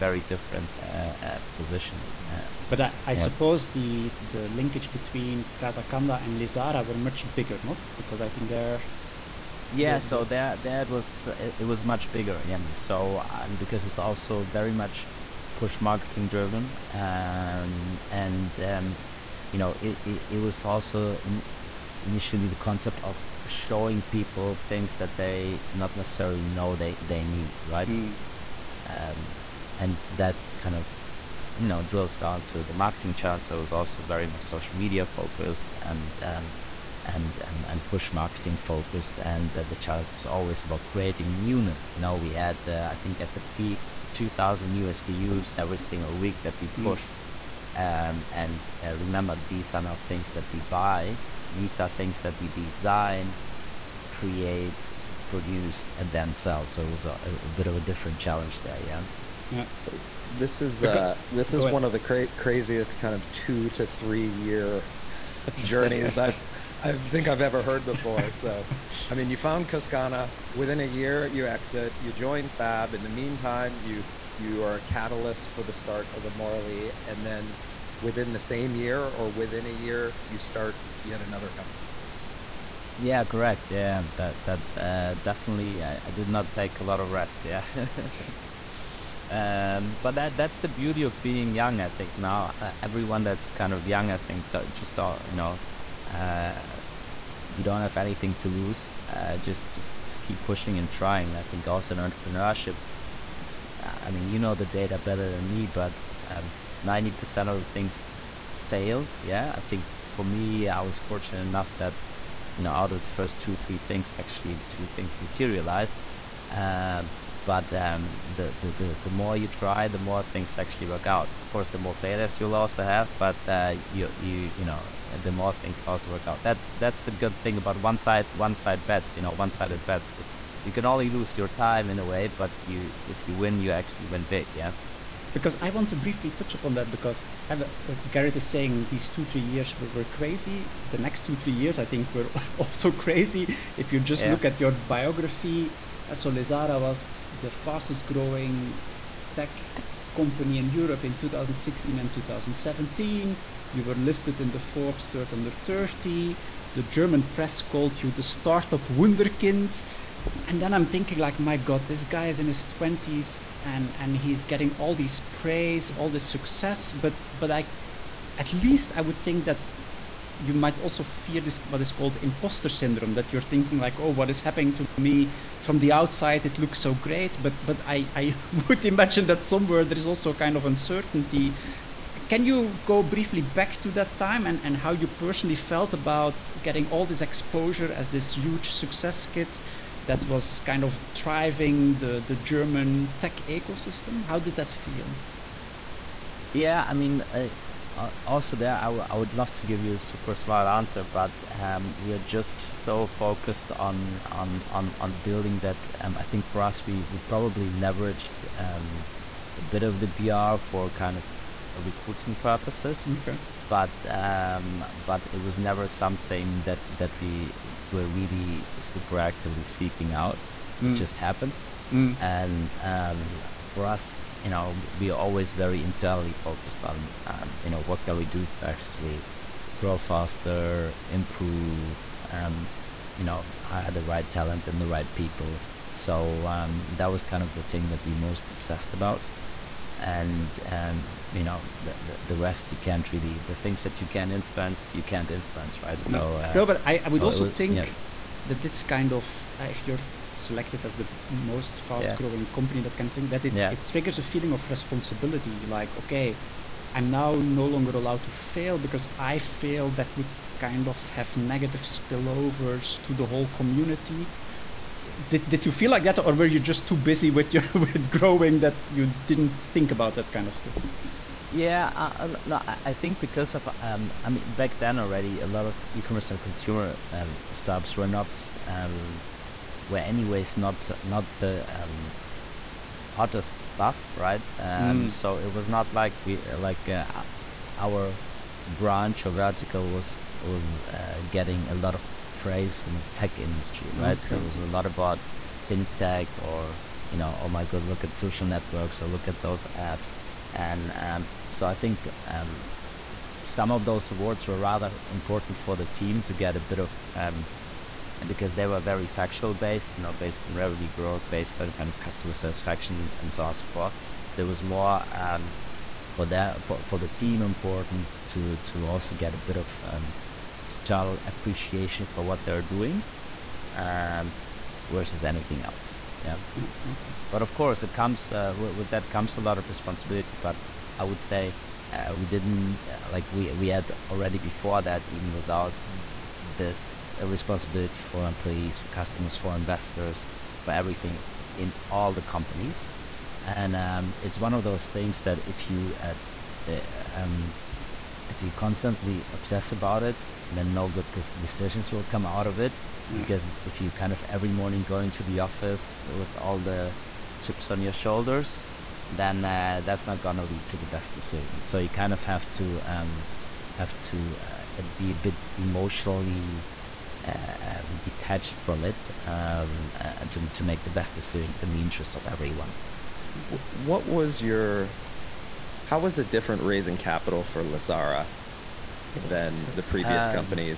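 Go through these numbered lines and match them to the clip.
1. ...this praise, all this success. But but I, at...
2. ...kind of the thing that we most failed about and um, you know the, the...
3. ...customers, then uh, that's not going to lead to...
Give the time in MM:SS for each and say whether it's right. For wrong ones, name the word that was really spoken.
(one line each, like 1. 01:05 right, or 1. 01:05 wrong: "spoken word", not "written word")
1. 02:44 right
2. 03:57 wrong: "obsessed", not "failed"
3. 05:57 wrong: "shoulders", not "customers".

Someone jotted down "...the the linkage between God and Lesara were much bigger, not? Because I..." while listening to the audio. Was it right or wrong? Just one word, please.
wrong.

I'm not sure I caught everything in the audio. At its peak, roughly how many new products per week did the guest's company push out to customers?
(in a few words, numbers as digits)
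2,000.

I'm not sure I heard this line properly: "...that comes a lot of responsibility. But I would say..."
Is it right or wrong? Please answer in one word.
right.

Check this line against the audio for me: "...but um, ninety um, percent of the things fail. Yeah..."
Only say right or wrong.
right.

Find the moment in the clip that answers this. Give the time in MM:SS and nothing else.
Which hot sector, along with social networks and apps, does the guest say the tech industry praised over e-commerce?
04:55.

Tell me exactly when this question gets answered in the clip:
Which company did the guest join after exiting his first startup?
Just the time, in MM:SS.
01:12.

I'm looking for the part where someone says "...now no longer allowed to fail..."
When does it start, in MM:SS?
04:17.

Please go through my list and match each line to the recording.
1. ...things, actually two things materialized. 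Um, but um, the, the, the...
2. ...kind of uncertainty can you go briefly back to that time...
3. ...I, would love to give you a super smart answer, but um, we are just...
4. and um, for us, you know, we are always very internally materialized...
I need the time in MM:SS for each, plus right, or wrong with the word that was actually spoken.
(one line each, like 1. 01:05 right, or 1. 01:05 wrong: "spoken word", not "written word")
1. 01:53 right
2. 03:00 right
3. 03:18 right
4. 03:42 wrong: "focused", not "materialized".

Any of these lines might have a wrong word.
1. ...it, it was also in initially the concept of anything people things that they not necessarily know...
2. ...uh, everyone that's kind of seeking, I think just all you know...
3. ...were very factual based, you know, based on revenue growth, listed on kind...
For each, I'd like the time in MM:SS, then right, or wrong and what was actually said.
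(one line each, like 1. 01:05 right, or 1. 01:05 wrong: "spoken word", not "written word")
1. 00:20 wrong: "showing", not "anything"
2. 01:32 wrong: "young", not "seeking"
3. 05:08 wrong: "based", not "listed".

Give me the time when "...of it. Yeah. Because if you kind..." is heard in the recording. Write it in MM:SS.
05:52.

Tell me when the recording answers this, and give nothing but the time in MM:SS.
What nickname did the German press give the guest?
02:38.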